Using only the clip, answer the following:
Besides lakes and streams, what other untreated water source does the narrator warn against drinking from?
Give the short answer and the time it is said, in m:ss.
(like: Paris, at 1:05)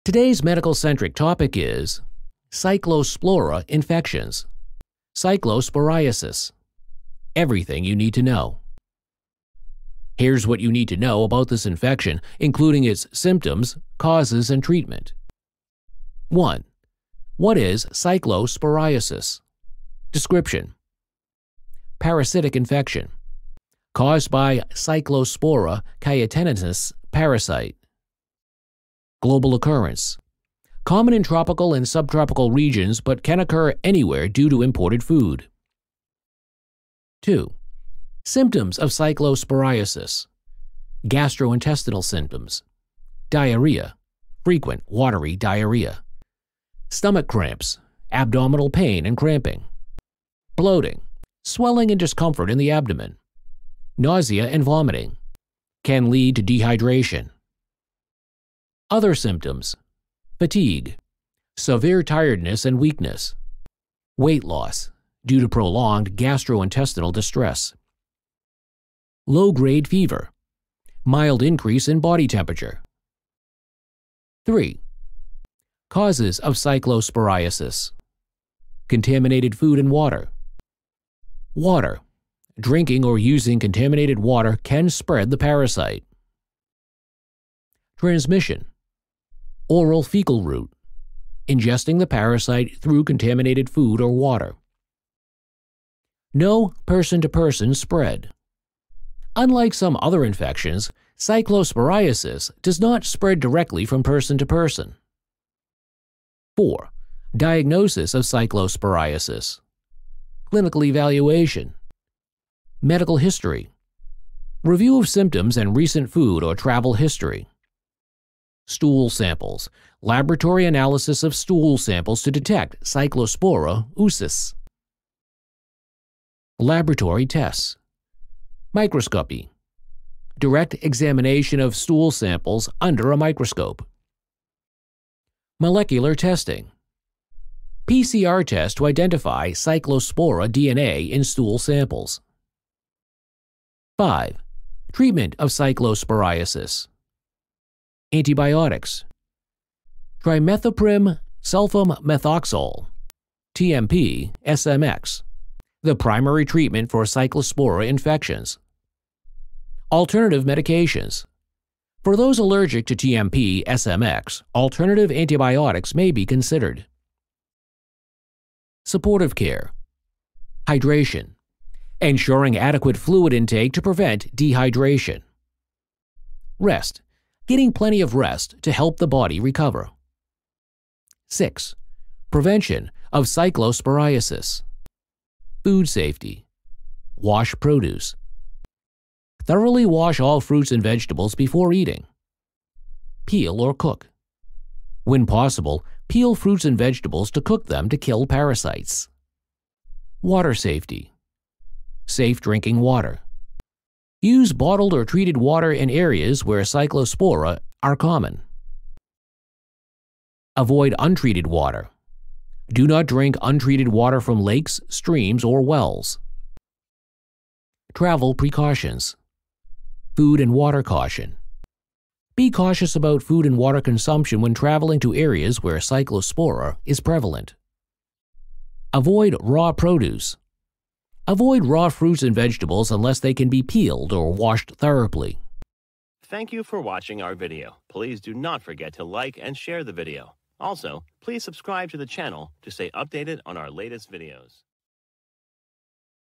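Wells, at 3:35.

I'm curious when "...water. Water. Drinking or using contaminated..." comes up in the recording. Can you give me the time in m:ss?
1:19.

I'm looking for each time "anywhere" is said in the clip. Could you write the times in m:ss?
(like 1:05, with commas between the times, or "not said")
0:33.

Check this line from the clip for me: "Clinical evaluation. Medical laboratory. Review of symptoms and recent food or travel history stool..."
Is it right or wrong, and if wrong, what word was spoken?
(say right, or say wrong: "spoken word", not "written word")
wrong: "history", not "laboratory".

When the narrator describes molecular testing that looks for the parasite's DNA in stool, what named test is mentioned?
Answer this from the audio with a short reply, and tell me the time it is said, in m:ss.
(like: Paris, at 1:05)
PCR test, at 2:17.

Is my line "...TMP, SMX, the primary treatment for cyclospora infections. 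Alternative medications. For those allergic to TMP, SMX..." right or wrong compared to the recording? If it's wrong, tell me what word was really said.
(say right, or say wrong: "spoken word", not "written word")
right.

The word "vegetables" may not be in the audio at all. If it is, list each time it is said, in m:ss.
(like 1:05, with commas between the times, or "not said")
3:10, 3:16, 3:52.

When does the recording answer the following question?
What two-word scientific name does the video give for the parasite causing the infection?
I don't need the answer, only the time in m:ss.
0:24.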